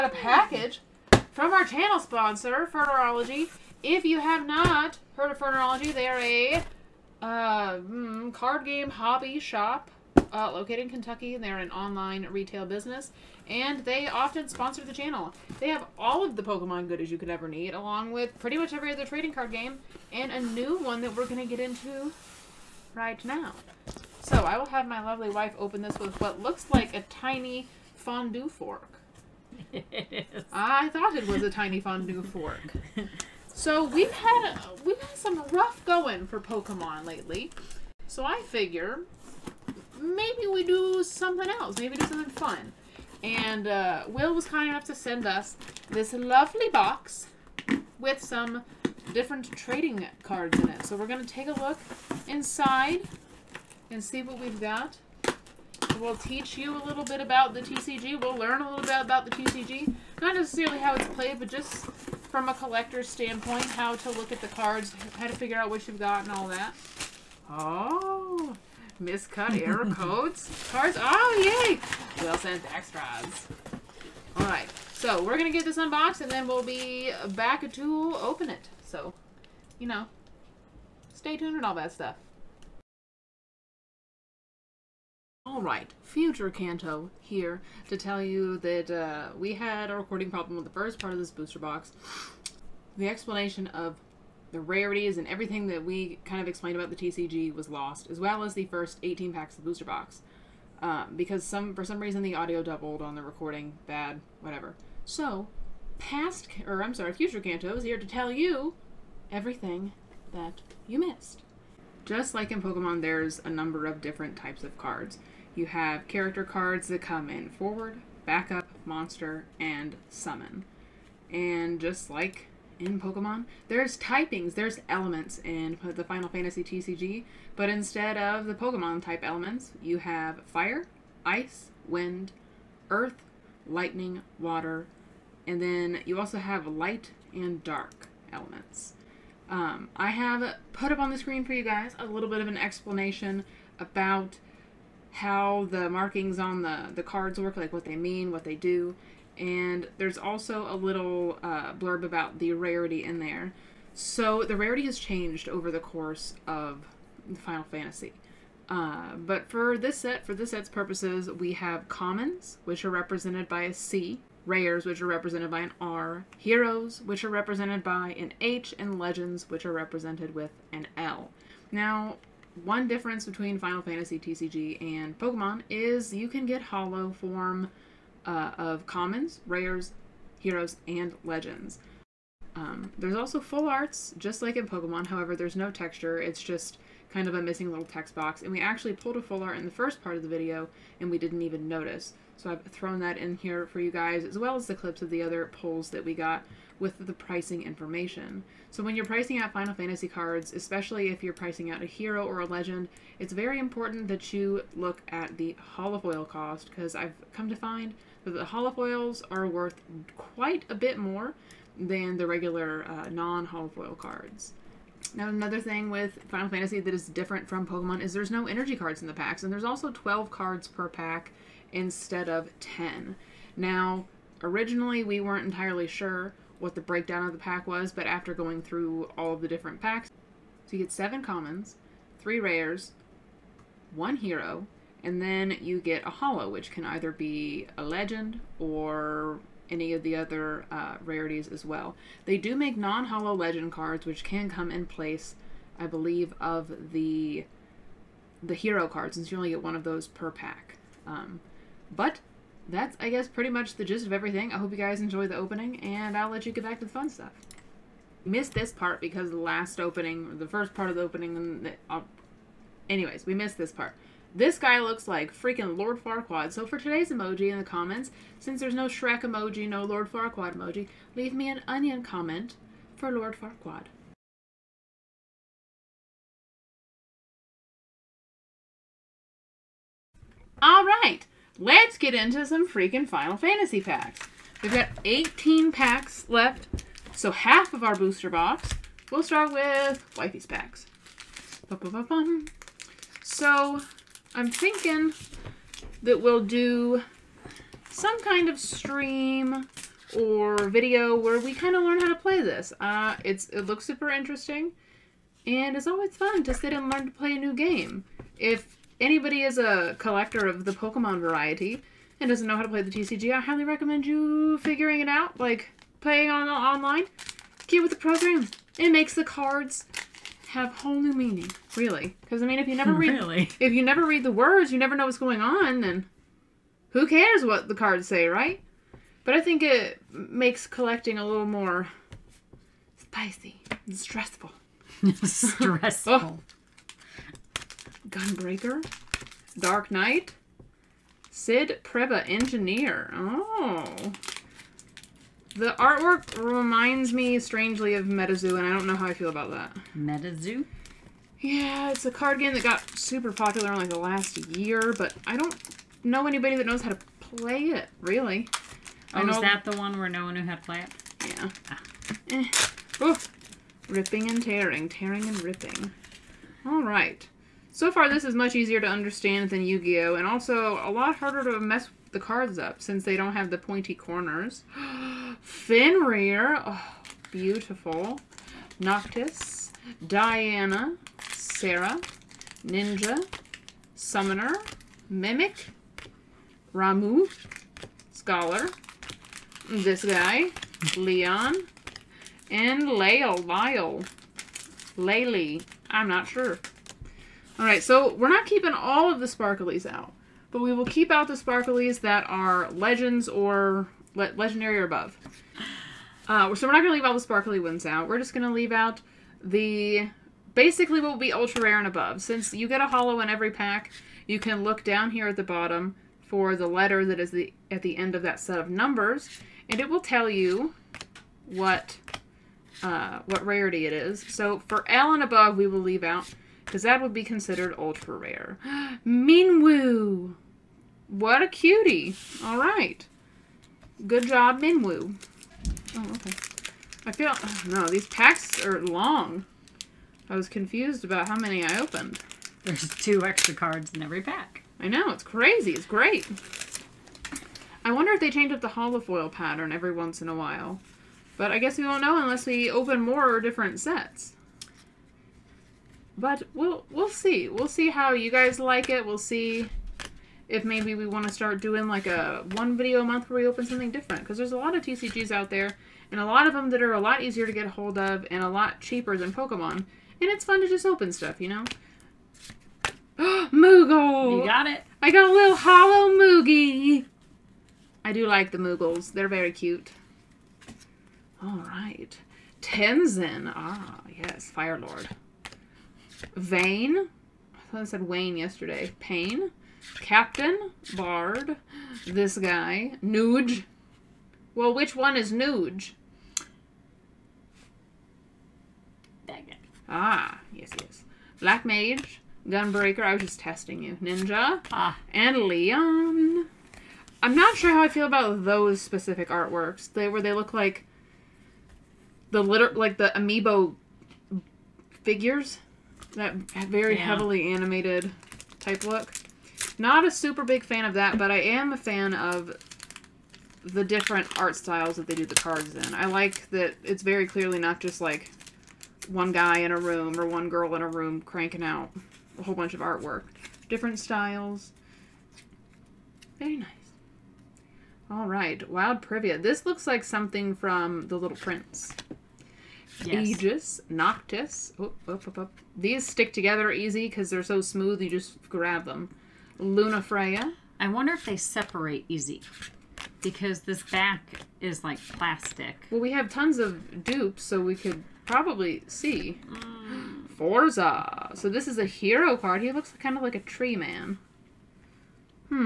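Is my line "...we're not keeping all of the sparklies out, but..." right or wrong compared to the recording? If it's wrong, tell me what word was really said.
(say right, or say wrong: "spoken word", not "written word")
right.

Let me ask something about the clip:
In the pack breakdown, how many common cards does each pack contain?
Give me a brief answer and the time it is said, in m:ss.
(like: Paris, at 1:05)
seven, at 3:50.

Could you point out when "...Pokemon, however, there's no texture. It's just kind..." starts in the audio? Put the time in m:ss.
3:04.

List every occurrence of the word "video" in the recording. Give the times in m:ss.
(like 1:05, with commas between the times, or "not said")
3:10, 5:00, 7:42.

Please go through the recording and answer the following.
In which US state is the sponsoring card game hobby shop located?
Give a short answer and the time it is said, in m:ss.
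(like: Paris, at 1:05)
Kentucky, at 0:10.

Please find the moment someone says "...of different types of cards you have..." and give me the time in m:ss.
1:53.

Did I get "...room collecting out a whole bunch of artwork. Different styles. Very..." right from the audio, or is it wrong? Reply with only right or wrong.
wrong.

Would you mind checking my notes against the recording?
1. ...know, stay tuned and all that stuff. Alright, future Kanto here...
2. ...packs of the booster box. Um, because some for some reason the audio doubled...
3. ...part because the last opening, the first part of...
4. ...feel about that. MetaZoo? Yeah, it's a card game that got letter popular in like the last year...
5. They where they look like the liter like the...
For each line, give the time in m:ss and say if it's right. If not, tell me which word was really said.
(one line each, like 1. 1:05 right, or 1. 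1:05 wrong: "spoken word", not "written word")
1. 1:19 right
2. 1:39 right
3. 4:18 right
4. 5:49 wrong: "super", not "letter"
5. 8:29 right.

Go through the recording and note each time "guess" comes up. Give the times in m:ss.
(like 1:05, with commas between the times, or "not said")
4:13, 7:31.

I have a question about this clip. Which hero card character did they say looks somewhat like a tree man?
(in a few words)
Forza.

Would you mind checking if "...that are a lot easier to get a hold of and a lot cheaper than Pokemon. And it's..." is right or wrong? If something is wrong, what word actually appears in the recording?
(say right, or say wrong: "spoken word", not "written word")
right.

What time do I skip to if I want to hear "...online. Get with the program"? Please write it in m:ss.
5:16.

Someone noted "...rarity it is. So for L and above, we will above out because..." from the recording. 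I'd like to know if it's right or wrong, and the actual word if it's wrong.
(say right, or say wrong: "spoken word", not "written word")
wrong: "leave", not "above".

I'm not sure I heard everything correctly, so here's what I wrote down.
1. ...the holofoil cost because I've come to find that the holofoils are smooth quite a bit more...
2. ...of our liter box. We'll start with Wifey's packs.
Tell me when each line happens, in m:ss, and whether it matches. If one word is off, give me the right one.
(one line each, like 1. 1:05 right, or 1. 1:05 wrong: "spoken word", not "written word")
1. 3:25 wrong: "worth", not "smooth"
2. 4:47 wrong: "booster", not "liter".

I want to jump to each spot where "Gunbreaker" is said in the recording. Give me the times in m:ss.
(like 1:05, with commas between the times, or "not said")
5:38, 8:22.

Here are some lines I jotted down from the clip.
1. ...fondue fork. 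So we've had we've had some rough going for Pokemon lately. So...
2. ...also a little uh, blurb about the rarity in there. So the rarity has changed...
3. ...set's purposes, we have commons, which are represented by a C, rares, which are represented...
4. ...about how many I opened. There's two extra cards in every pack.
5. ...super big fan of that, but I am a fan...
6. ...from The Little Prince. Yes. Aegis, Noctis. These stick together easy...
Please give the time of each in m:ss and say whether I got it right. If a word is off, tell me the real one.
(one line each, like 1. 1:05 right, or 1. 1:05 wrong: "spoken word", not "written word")
1. 0:31 right
2. 2:30 right
3. 2:40 right
4. 7:21 right
5. 8:40 right
6. 9:00 right.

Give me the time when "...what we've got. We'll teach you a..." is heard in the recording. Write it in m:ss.
0:54.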